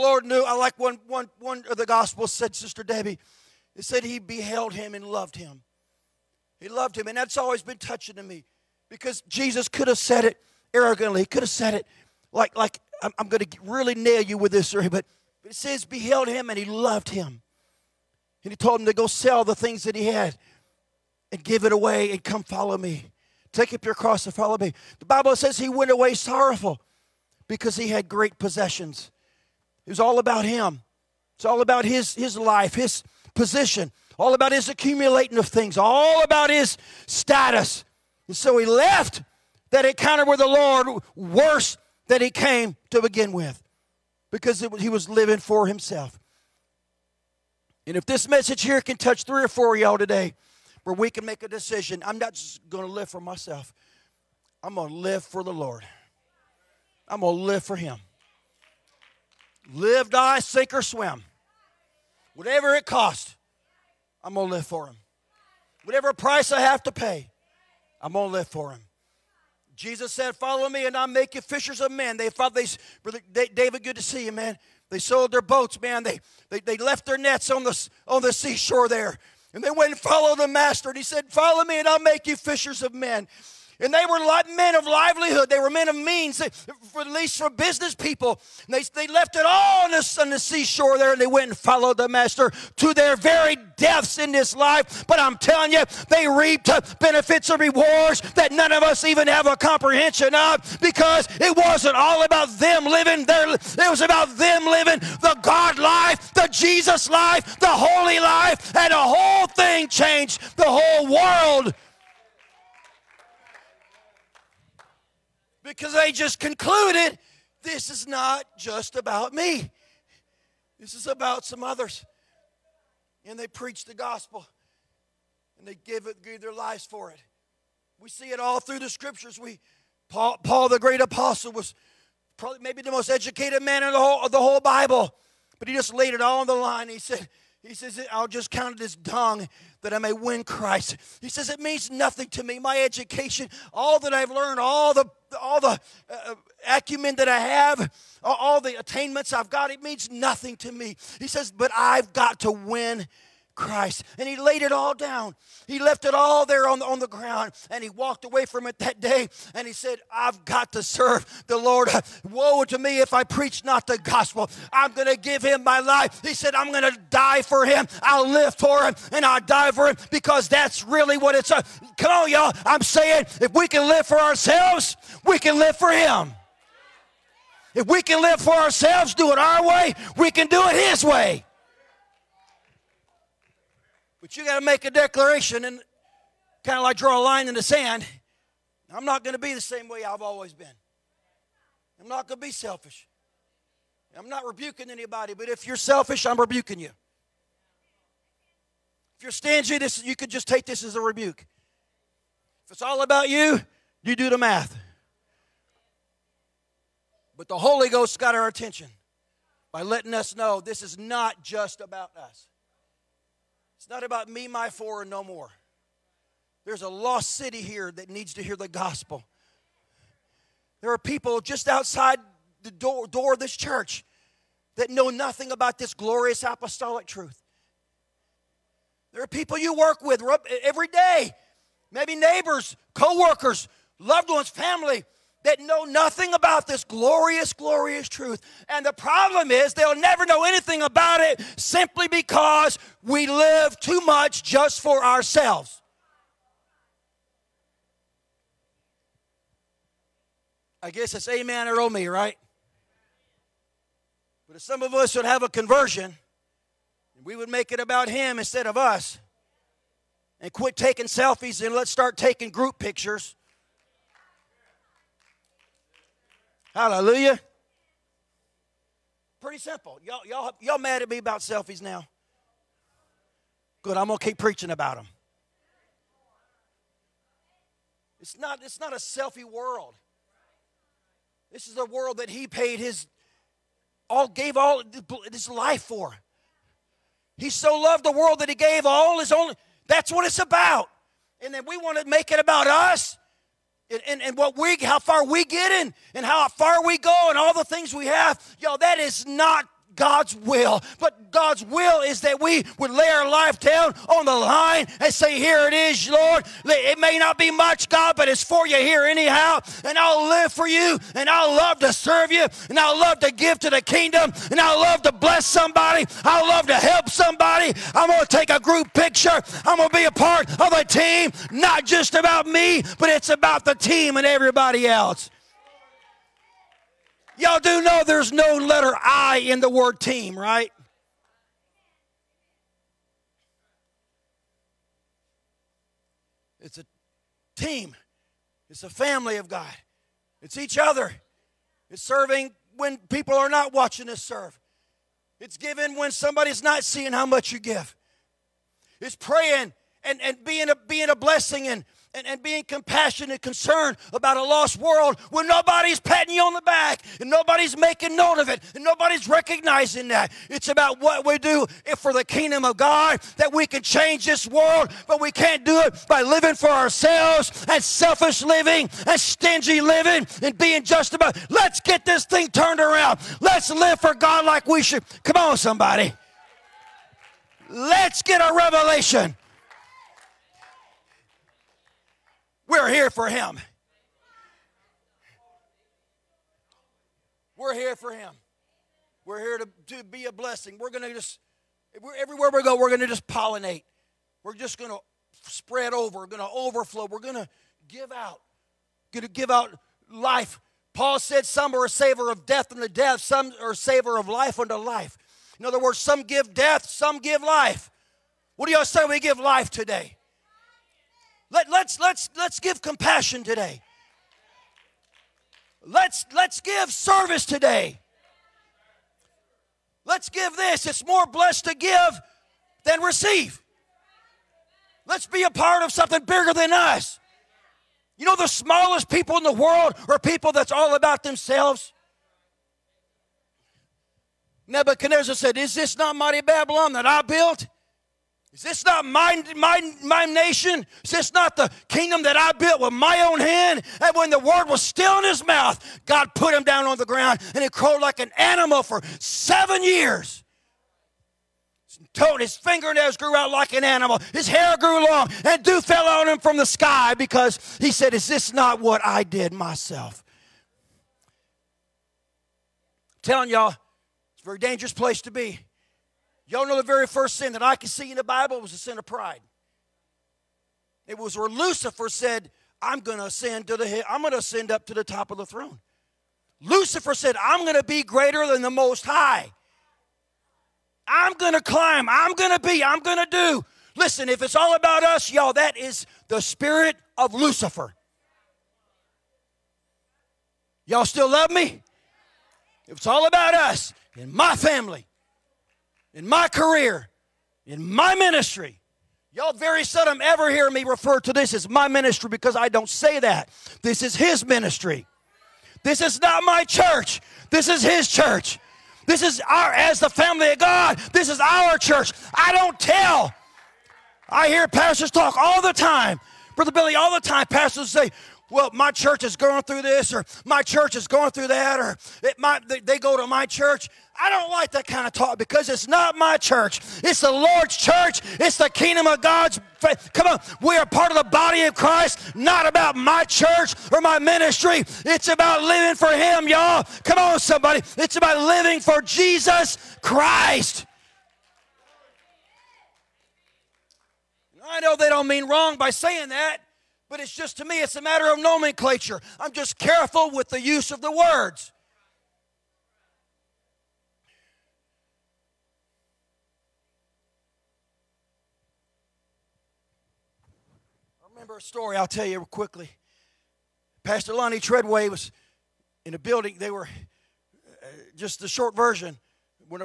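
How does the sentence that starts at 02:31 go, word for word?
He says, But I've got to win Christ.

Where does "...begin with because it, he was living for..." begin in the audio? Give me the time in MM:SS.
00:42.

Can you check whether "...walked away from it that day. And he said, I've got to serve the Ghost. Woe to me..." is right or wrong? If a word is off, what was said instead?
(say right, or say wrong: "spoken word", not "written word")
wrong: "Lord", not "Ghost".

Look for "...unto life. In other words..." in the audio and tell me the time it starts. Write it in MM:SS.
06:44.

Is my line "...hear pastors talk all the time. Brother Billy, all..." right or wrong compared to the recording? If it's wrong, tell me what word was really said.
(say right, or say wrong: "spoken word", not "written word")
right.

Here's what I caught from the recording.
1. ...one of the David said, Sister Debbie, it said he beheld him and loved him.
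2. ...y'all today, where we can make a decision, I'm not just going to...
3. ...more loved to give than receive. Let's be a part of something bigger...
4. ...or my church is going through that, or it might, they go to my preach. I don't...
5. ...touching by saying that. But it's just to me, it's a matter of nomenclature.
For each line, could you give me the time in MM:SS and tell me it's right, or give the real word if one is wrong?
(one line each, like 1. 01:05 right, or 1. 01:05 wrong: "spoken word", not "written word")
1. 00:01 wrong: "Gospels", not "David"
2. 00:49 right
3. 07:01 wrong: "blessed", not "loved"
4. 08:40 wrong: "church", not "preach"
5. 09:05 wrong: "wrong", not "touching".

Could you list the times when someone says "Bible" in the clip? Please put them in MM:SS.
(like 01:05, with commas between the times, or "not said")
00:25, 02:14, 07:48.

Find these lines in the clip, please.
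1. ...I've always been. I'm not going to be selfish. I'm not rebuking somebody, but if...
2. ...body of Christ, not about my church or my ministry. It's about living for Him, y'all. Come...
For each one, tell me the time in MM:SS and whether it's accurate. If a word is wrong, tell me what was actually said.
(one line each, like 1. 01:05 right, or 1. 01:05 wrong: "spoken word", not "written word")
1. 03:10 wrong: "anybody", not "somebody"
2. 08:51 right.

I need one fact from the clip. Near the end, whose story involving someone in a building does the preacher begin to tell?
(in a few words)
Pastor Lonnie Treadway.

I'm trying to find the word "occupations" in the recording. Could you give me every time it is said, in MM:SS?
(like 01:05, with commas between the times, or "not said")
not said.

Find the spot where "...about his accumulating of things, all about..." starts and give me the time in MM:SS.
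00:34.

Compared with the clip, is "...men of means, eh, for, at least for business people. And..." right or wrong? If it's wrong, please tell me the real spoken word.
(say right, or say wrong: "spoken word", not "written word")
right.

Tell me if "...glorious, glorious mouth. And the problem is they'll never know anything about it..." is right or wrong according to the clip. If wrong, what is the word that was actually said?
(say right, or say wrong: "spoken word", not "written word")
wrong: "truth", not "mouth".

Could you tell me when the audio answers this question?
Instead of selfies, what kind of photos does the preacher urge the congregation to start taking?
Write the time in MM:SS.
04:22.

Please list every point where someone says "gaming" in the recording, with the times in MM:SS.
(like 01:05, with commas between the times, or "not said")
not said.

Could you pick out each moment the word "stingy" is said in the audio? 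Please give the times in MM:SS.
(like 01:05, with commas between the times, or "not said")
03:19, 06:09.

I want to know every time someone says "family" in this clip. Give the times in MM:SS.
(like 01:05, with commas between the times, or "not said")
03:54, 05:38, 08:14, 08:30.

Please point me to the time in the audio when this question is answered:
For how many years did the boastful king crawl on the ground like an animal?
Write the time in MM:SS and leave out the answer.
07:29.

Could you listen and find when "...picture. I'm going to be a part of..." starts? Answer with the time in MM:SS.
05:18.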